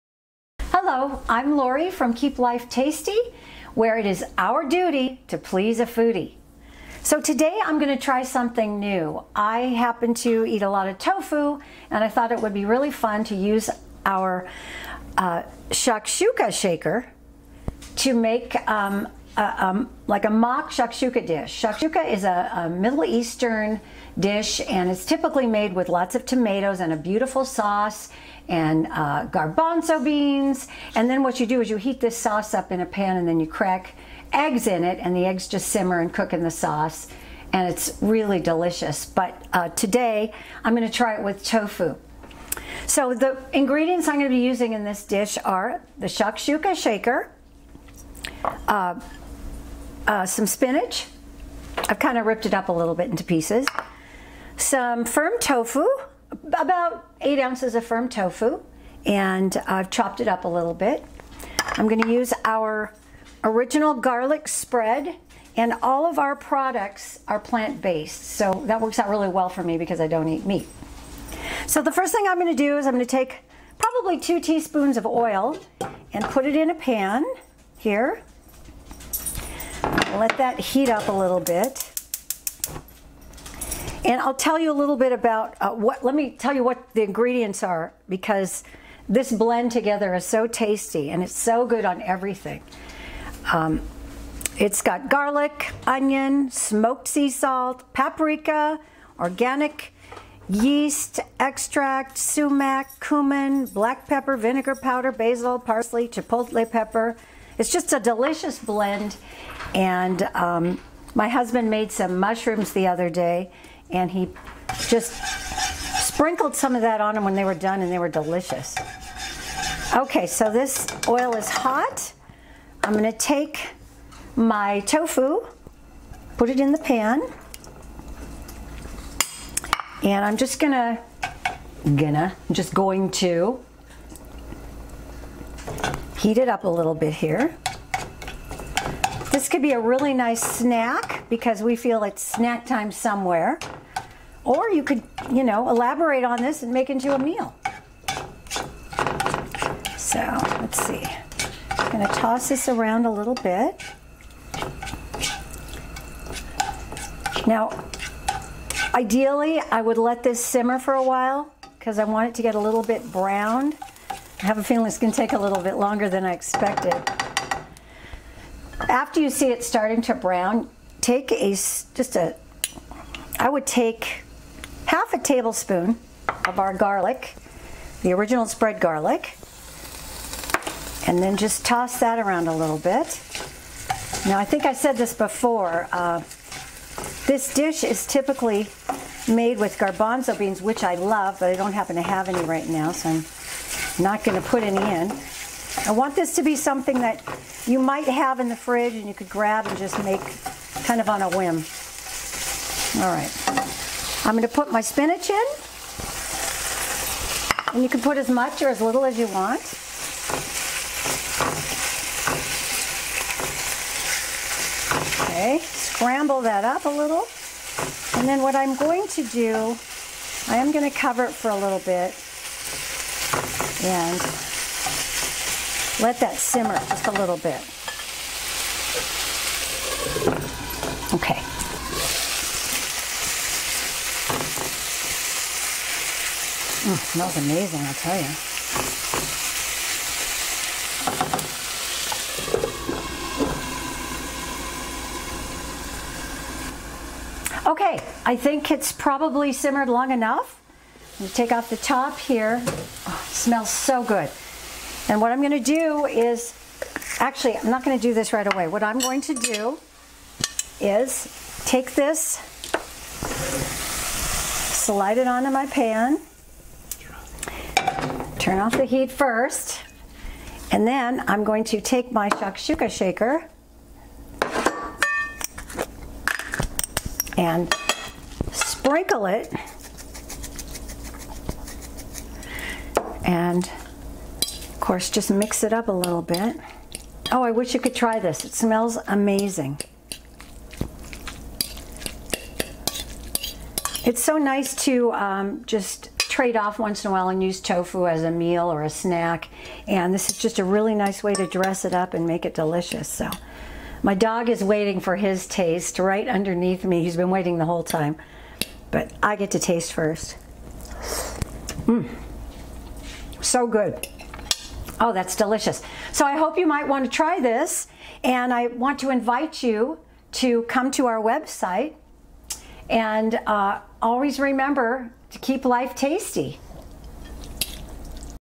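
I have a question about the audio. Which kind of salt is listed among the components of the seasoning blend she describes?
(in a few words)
smoked sea salt.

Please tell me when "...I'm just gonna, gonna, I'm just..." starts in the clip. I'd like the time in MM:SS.
02:10.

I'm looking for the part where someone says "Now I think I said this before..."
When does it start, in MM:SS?
03:04.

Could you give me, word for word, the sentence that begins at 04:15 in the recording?
And what I'm going to do is, actually, I'm not going to do this right away.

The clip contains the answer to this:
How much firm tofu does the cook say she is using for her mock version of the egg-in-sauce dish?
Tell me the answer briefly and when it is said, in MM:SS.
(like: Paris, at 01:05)
8 ounces, at 00:57.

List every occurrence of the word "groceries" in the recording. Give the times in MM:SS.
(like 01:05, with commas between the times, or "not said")
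not said.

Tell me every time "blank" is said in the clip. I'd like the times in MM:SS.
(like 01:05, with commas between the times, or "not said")
not said.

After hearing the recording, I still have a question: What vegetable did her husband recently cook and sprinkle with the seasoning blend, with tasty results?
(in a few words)
mushrooms.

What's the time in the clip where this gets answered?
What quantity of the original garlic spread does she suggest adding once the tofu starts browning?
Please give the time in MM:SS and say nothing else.
02:54.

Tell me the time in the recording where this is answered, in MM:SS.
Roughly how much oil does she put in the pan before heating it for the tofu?
01:14.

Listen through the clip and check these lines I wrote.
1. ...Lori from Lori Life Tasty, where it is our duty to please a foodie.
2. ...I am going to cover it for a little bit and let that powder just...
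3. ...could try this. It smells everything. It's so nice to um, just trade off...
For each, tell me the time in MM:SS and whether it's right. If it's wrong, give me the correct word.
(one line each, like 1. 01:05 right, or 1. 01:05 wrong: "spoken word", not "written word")
1. 00:01 wrong: "Keep", not "Lori"
2. 03:40 wrong: "simmer", not "powder"
3. 04:47 wrong: "amazing", not "everything".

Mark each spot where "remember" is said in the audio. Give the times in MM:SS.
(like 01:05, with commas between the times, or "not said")
05:24.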